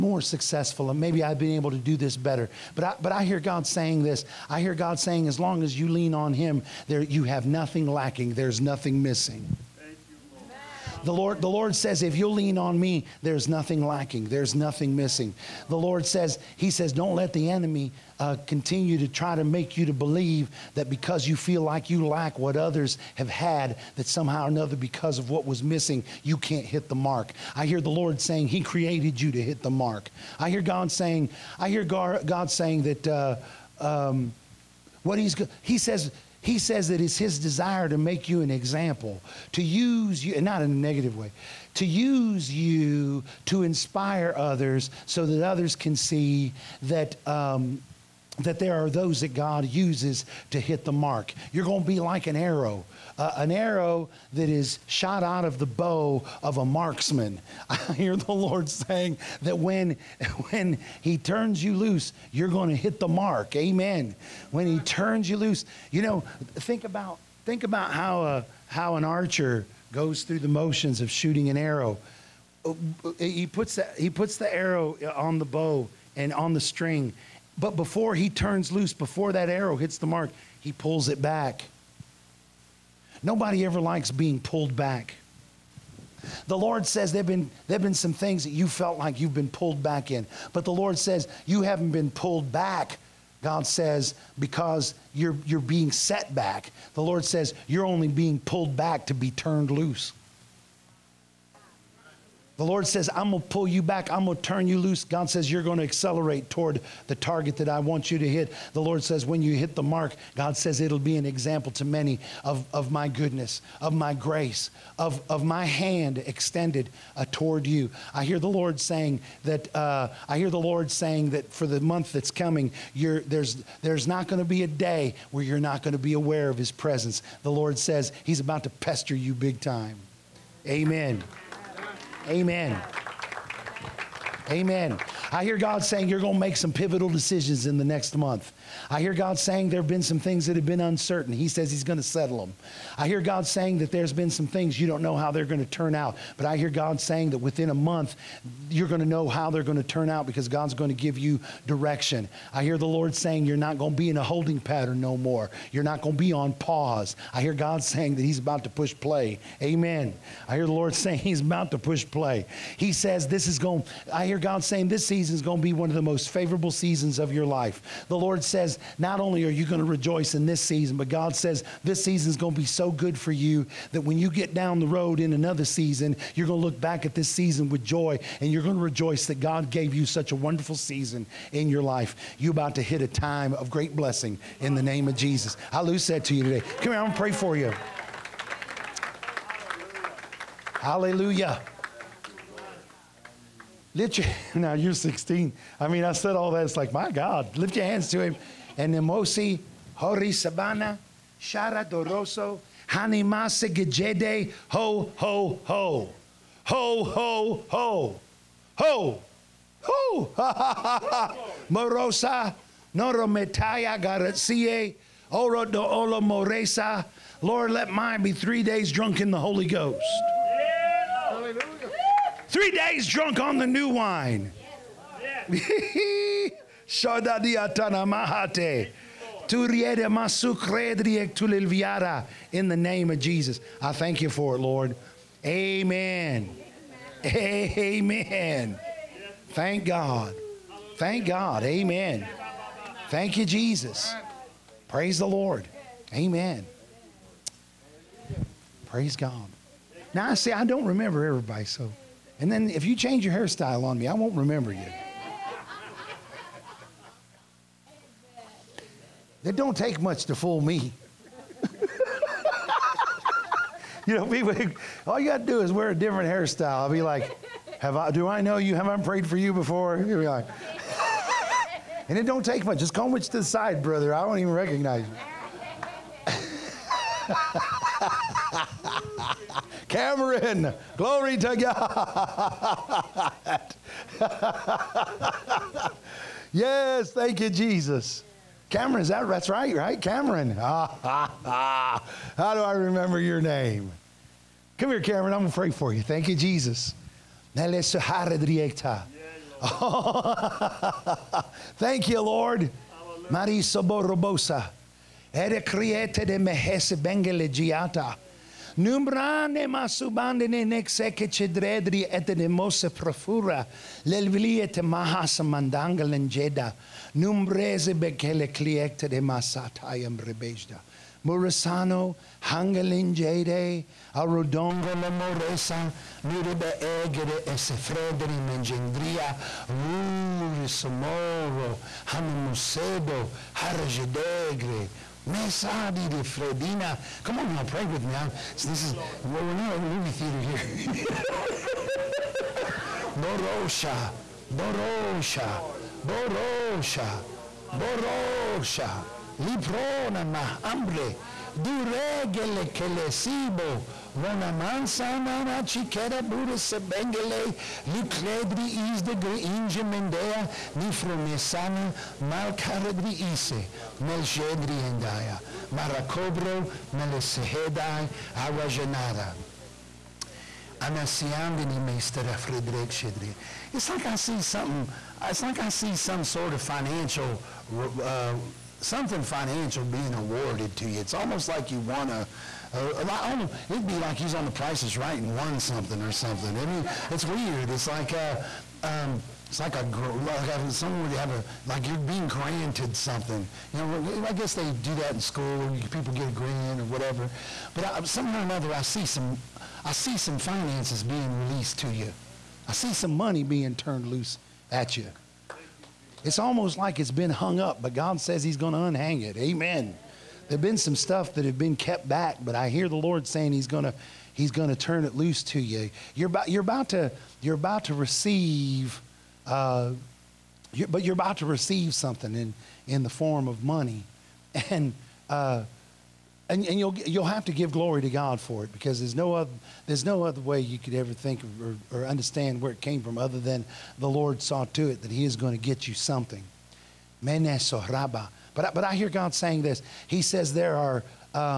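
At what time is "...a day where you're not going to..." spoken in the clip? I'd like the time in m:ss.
2:04.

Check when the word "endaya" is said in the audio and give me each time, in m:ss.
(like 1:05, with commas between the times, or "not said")
6:04.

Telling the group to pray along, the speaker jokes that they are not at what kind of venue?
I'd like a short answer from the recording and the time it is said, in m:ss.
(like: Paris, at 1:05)
a movie theater, at 5:39.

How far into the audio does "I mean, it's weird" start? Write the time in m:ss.
6:26.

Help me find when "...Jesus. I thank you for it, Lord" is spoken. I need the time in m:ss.
3:53.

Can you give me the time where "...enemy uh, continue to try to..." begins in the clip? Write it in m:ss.
0:17.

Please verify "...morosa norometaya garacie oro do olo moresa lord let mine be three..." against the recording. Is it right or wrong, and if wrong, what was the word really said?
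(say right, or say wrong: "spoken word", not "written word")
right.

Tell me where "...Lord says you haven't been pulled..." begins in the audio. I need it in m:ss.
1:30.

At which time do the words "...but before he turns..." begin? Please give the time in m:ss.
1:17.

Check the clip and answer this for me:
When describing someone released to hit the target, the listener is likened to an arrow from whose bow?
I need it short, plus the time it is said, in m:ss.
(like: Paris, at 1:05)
a marksman, at 0:56.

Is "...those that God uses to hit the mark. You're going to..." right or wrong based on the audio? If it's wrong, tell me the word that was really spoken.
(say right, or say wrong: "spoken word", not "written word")
right.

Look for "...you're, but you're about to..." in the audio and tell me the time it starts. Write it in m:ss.
7:00.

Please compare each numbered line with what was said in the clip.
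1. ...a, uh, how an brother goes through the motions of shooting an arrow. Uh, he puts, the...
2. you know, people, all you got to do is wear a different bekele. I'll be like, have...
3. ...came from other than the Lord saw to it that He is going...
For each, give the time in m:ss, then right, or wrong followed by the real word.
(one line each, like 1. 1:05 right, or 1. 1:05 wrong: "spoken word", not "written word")
1. 1:08 wrong: "archer", not "brother"
2. 4:24 wrong: "hairstyle", not "bekele"
3. 7:12 right.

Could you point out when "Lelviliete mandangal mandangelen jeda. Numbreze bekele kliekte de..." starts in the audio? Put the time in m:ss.
5:14.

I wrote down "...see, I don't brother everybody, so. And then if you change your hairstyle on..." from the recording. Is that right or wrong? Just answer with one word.
wrong.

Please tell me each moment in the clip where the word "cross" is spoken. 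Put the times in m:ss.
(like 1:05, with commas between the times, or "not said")
not said.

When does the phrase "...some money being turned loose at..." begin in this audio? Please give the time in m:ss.
6:42.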